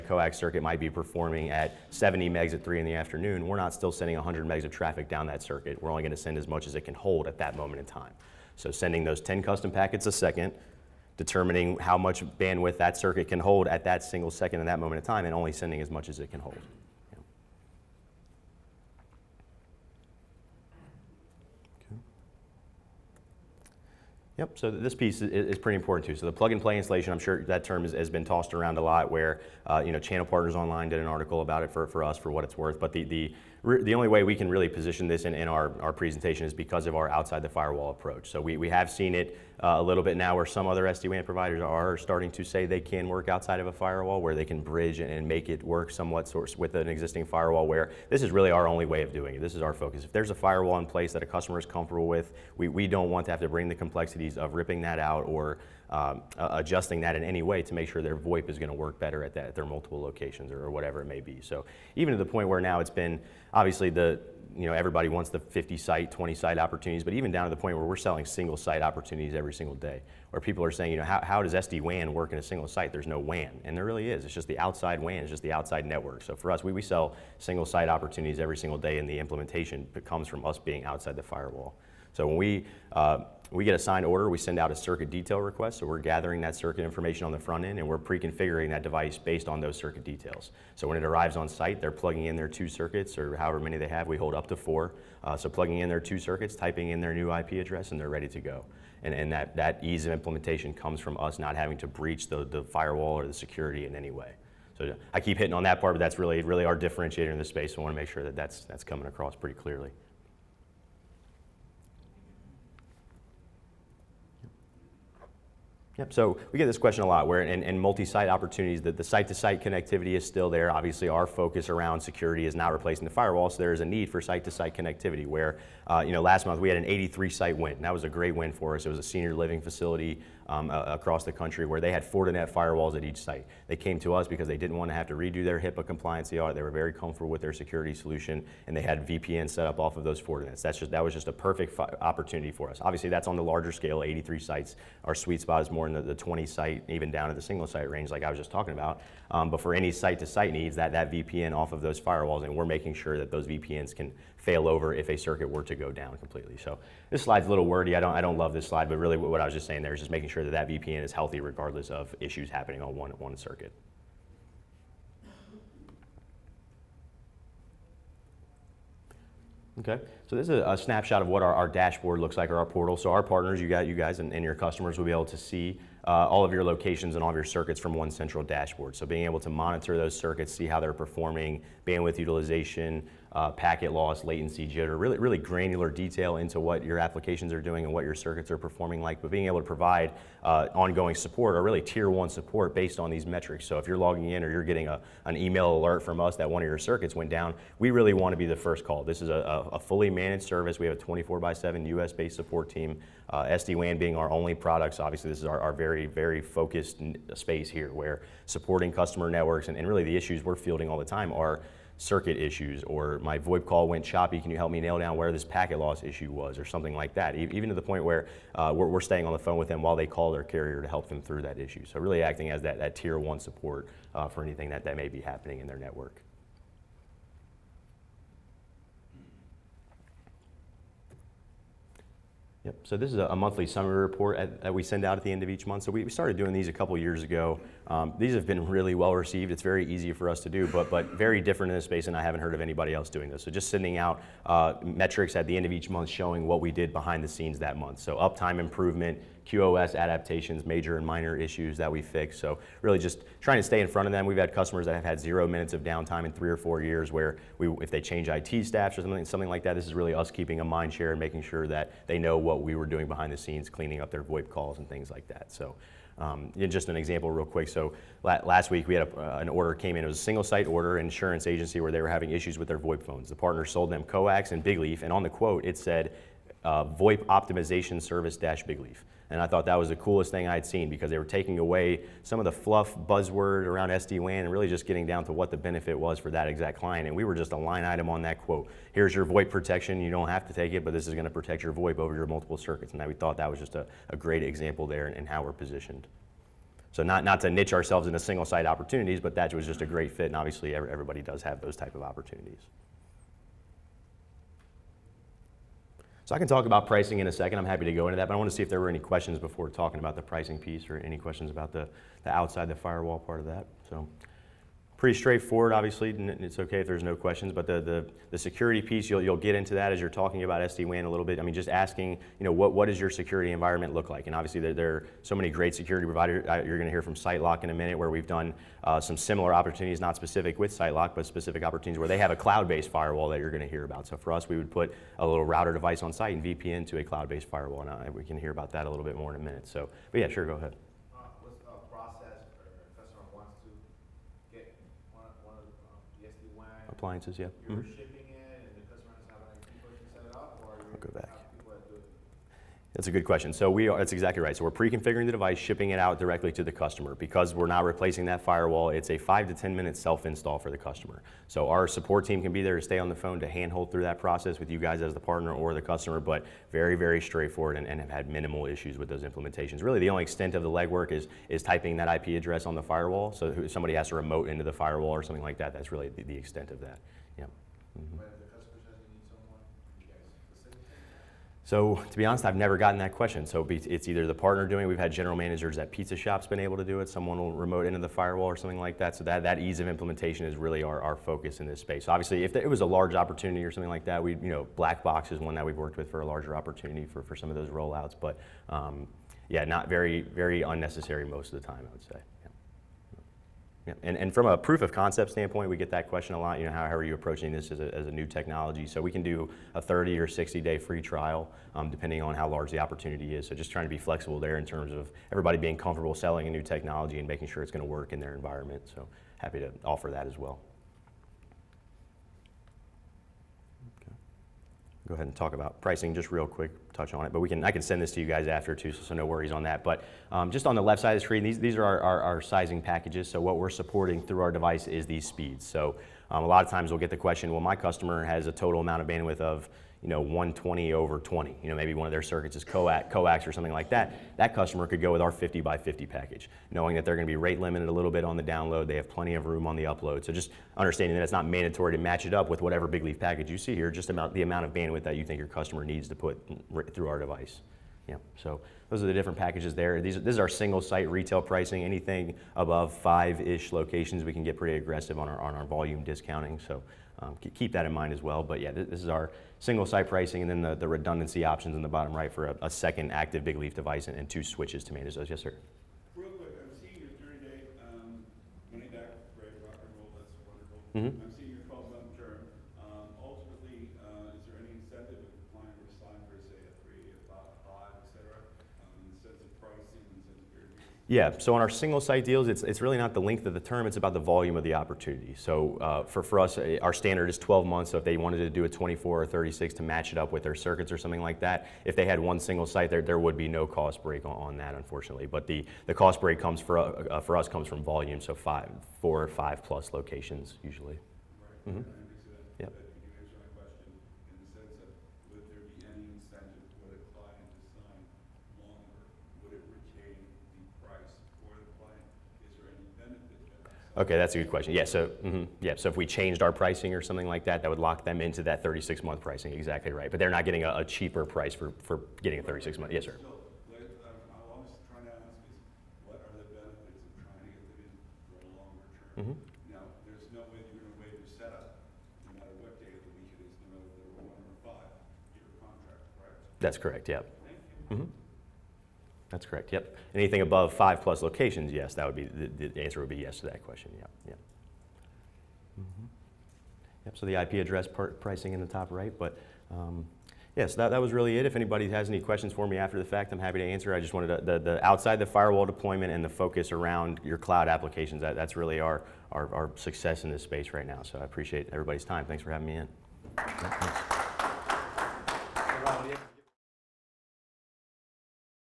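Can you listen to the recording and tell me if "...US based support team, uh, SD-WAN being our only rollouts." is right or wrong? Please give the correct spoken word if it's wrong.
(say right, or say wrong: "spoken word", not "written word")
wrong: "products", not "rollouts".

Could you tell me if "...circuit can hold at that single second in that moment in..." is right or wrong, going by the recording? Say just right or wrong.
right.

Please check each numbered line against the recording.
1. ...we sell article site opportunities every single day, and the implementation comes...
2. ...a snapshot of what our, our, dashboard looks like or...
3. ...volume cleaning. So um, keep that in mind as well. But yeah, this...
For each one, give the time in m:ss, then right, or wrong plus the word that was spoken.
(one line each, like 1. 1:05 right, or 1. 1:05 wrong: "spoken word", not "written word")
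1. 1:16 wrong: "single", not "article"
2. 2:50 right
3. 7:45 wrong: "discounting", not "cleaning".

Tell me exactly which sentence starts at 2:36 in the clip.
So this slide's a little wordy.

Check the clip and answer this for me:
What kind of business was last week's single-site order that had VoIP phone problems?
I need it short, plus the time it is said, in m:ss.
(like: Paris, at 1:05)
insurance agency, at 4:30.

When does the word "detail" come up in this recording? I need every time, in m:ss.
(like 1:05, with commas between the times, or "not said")
1:25, 1:30, 3:05.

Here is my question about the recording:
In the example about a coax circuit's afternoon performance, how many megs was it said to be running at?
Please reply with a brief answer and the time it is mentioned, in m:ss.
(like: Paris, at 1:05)
70, at 0:01.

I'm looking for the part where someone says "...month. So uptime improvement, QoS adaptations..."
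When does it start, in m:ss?
4:07.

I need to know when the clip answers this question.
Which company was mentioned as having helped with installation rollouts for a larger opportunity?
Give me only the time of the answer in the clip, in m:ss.
6:34.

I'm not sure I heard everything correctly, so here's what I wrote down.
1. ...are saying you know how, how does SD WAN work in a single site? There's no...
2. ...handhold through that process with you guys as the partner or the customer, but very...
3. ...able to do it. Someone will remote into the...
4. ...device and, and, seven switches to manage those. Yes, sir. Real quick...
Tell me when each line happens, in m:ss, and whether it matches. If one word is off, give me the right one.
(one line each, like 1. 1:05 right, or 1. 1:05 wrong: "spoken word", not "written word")
1. 1:10 right
2. 6:03 right
3. 6:26 right
4. 7:53 wrong: "two", not "seven".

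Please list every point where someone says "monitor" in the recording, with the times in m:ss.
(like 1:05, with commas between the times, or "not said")
2:59.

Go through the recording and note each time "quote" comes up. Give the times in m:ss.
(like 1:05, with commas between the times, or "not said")
4:35, 4:48.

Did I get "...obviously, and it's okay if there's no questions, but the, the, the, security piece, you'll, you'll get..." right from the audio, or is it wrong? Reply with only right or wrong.
right.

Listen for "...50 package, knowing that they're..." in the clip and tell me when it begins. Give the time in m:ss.
7:25.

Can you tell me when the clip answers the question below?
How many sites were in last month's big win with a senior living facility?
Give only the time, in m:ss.
2:06.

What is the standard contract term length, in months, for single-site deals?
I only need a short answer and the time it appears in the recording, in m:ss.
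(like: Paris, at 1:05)
12 months, at 8:17.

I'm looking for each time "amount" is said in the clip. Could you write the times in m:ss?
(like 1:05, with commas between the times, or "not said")
7:18, 7:34.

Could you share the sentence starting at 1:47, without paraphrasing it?
So I want to make sure that that's, that's coming across pretty clearly.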